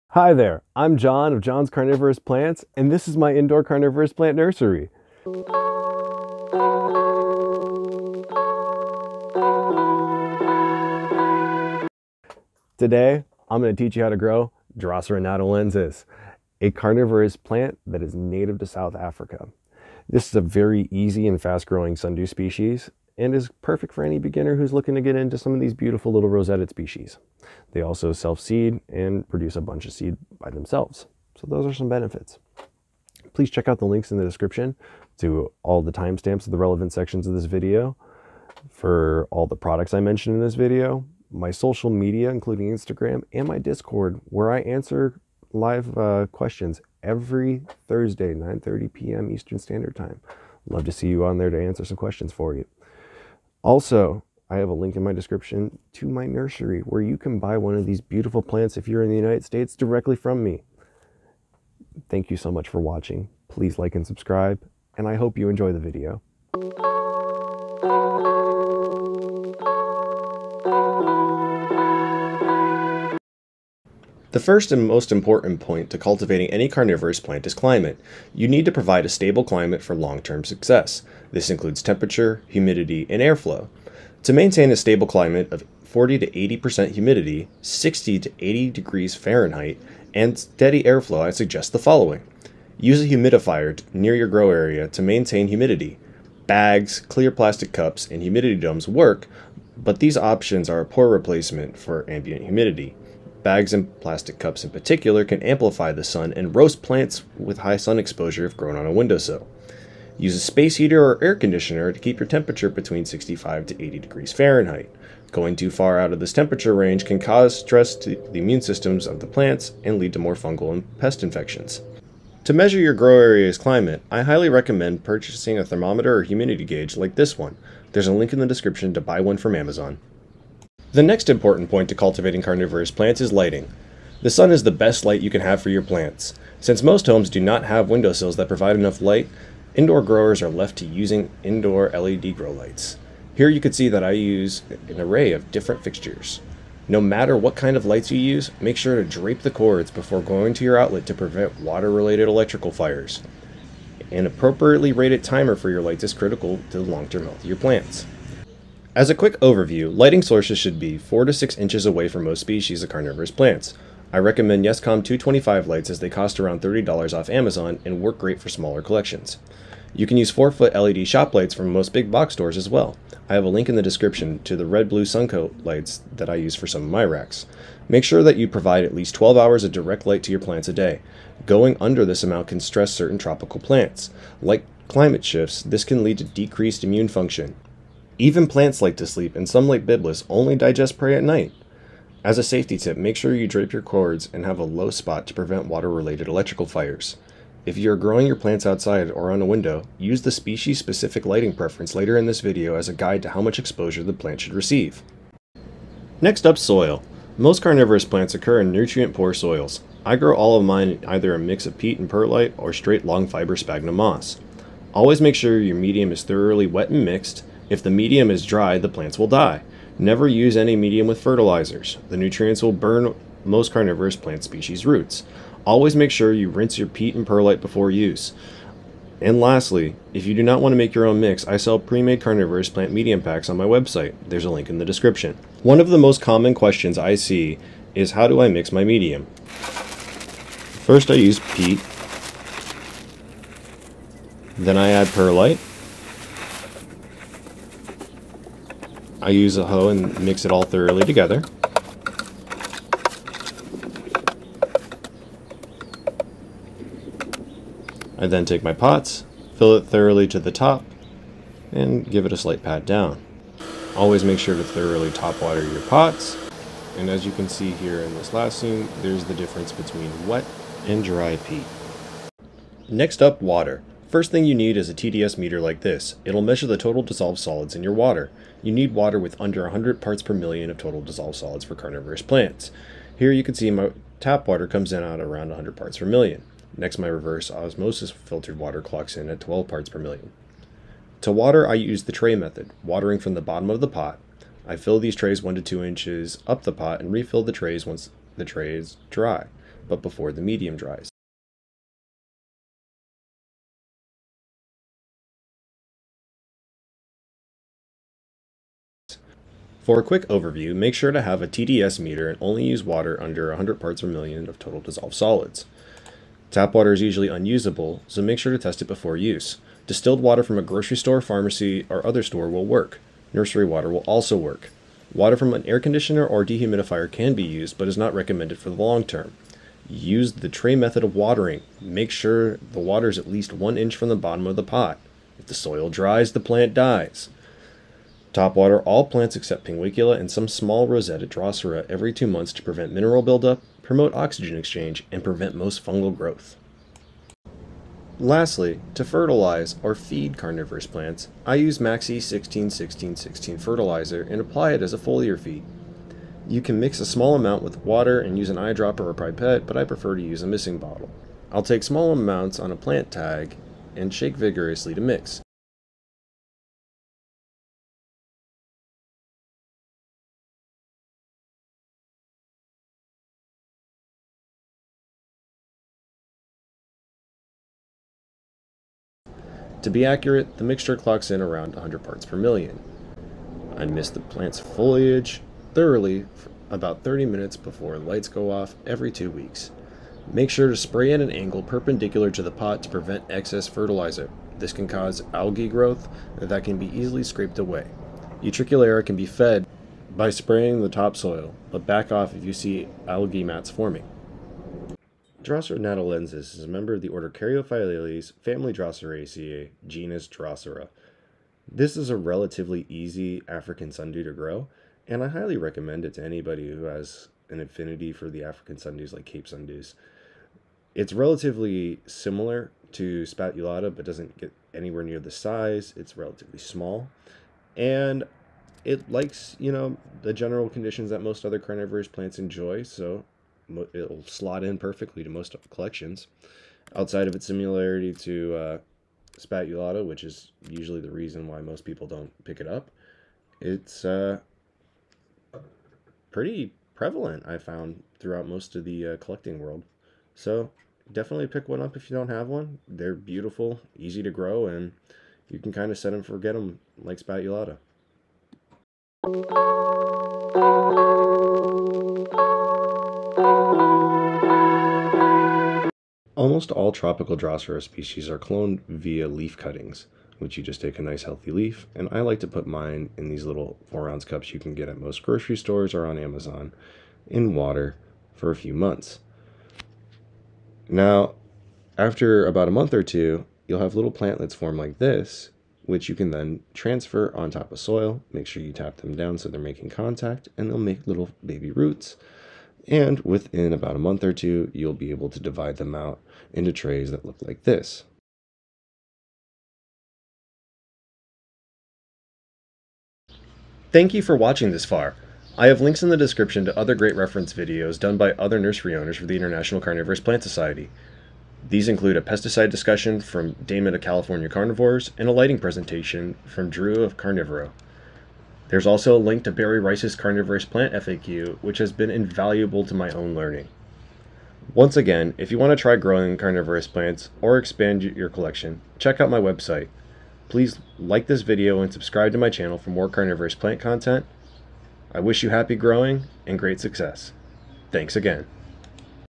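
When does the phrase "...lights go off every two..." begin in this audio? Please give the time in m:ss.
6:27.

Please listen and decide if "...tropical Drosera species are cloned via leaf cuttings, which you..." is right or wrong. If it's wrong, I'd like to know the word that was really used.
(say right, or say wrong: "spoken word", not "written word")
right.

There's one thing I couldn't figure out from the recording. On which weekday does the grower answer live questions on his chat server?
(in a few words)
Thursday.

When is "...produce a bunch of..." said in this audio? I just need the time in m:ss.
0:29.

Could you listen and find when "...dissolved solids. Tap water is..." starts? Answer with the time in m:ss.
5:14.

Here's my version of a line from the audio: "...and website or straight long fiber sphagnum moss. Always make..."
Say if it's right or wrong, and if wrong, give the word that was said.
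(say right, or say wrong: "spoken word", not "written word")
wrong: "perlite", not "website".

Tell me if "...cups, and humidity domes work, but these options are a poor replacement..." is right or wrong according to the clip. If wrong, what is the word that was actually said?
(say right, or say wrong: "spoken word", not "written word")
right.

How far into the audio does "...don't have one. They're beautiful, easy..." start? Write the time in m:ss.
7:32.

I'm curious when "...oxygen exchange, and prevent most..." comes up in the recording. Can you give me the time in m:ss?
5:44.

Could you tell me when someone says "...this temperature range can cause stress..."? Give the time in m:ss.
1:56.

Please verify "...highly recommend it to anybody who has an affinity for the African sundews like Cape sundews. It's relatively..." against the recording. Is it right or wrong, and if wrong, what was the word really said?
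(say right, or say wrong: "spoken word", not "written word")
right.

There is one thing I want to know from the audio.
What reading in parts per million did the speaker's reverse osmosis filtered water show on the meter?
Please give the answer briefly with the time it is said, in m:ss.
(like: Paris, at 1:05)
12, at 4:49.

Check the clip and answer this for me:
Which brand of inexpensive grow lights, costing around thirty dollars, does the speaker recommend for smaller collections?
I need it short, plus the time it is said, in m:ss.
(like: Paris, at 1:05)
Yescom 225, at 2:44.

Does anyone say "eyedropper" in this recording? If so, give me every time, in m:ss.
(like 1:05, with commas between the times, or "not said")
5:58.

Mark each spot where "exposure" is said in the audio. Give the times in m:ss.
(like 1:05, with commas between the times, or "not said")
1:47, 3:23.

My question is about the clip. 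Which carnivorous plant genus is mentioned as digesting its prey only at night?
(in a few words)
Byblis.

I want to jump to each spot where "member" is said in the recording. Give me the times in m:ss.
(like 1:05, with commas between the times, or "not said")
6:46.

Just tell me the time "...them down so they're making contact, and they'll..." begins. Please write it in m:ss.
8:08.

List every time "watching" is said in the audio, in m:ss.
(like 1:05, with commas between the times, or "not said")
1:02, 8:24.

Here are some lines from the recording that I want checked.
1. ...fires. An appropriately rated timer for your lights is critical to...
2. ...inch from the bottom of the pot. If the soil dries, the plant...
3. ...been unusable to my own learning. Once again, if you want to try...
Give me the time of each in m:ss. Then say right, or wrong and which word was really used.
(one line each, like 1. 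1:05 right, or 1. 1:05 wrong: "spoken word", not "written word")
1. 2:32 right
2. 5:33 right
3. 8:41 wrong: "invaluable", not "unusable".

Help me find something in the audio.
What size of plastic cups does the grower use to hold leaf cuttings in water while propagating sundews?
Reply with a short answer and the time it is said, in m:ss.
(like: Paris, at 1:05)
4 ounce, at 7:53.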